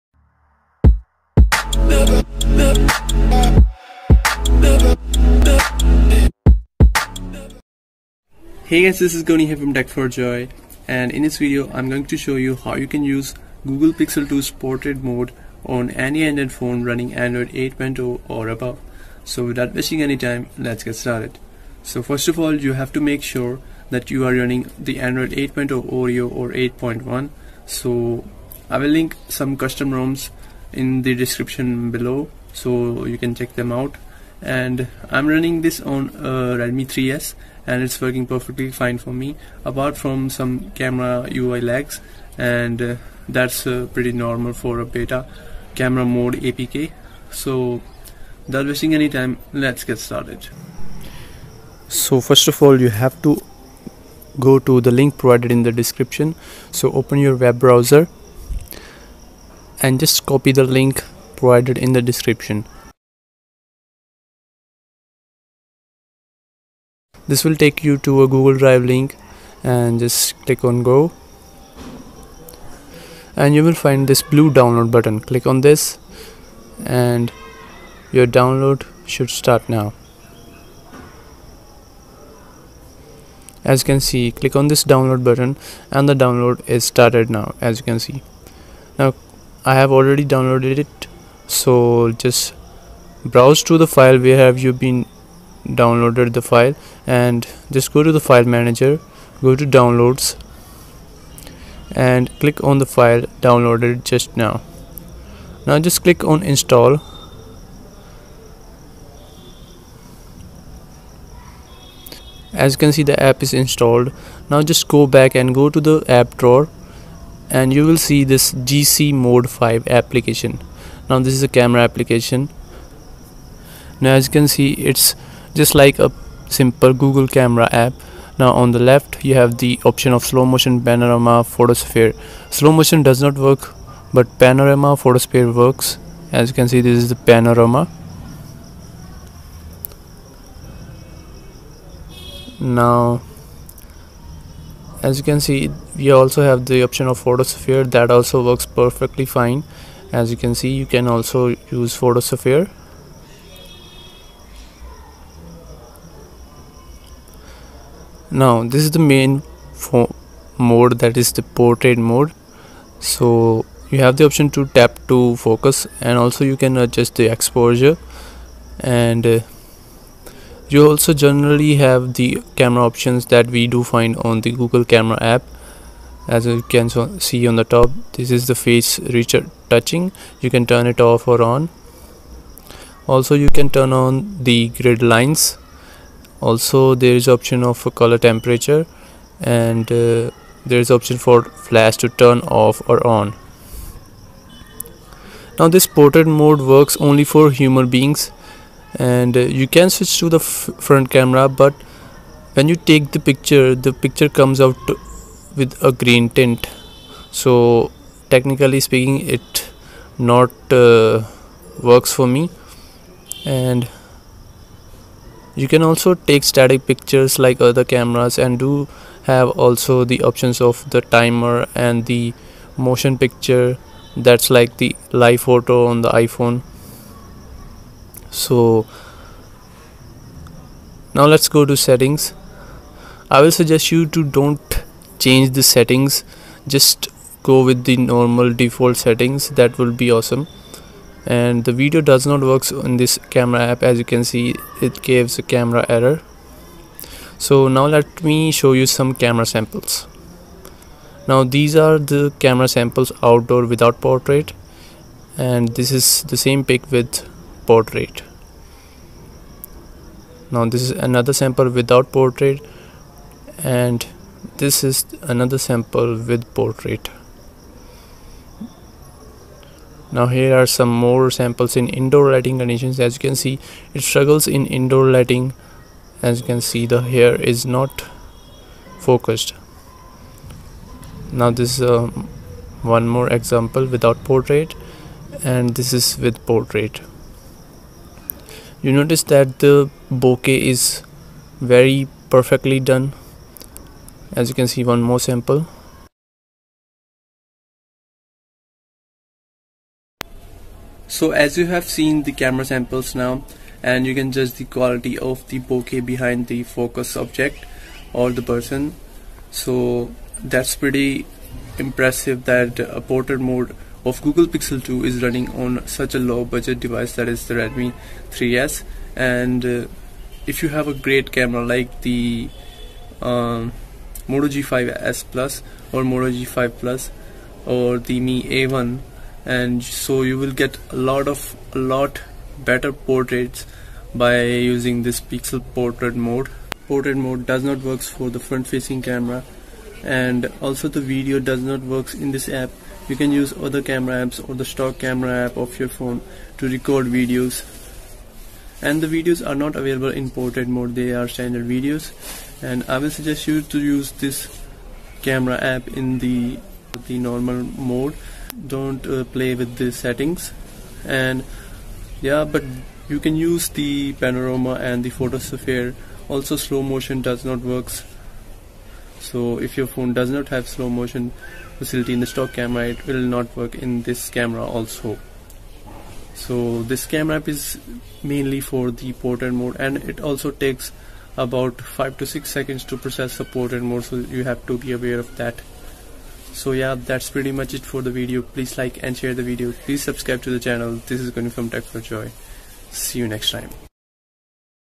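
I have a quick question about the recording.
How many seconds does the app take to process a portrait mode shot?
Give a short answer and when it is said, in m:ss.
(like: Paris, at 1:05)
5 to 6, at 6:21.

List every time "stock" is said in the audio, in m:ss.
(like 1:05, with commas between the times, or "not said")
5:44, 6:12.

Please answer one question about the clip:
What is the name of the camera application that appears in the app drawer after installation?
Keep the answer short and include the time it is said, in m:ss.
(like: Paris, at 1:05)
GC mode 5, at 1:58.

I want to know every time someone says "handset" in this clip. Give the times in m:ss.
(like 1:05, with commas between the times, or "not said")
not said.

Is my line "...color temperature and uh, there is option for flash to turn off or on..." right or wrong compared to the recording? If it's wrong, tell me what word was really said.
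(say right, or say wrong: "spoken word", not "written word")
right.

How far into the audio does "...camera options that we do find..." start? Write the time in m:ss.
2:52.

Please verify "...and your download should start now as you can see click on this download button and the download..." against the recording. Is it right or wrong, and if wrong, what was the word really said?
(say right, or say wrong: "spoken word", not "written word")
right.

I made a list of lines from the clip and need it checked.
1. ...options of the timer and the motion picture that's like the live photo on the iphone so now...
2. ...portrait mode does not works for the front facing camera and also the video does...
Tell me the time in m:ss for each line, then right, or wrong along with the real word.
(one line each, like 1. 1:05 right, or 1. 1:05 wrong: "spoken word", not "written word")
1. 3:40 right
2. 5:36 right.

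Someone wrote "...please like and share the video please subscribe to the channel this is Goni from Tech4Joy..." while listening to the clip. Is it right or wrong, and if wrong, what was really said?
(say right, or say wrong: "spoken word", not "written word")
right.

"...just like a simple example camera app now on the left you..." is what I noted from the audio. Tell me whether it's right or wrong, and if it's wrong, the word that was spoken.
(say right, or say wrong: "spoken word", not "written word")
wrong: "google", not "example".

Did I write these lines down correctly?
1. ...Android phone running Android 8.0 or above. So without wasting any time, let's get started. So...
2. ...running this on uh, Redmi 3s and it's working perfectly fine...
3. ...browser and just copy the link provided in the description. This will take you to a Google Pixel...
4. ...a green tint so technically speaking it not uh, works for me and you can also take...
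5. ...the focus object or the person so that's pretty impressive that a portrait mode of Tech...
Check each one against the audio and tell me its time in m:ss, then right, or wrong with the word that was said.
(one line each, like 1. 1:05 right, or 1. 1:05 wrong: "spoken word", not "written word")
1. 0:16 right
2. 0:35 right
3. 0:57 wrong: "Drive", not "Pixel"
4. 3:25 right
5. 5:06 wrong: "Google", not "Tech".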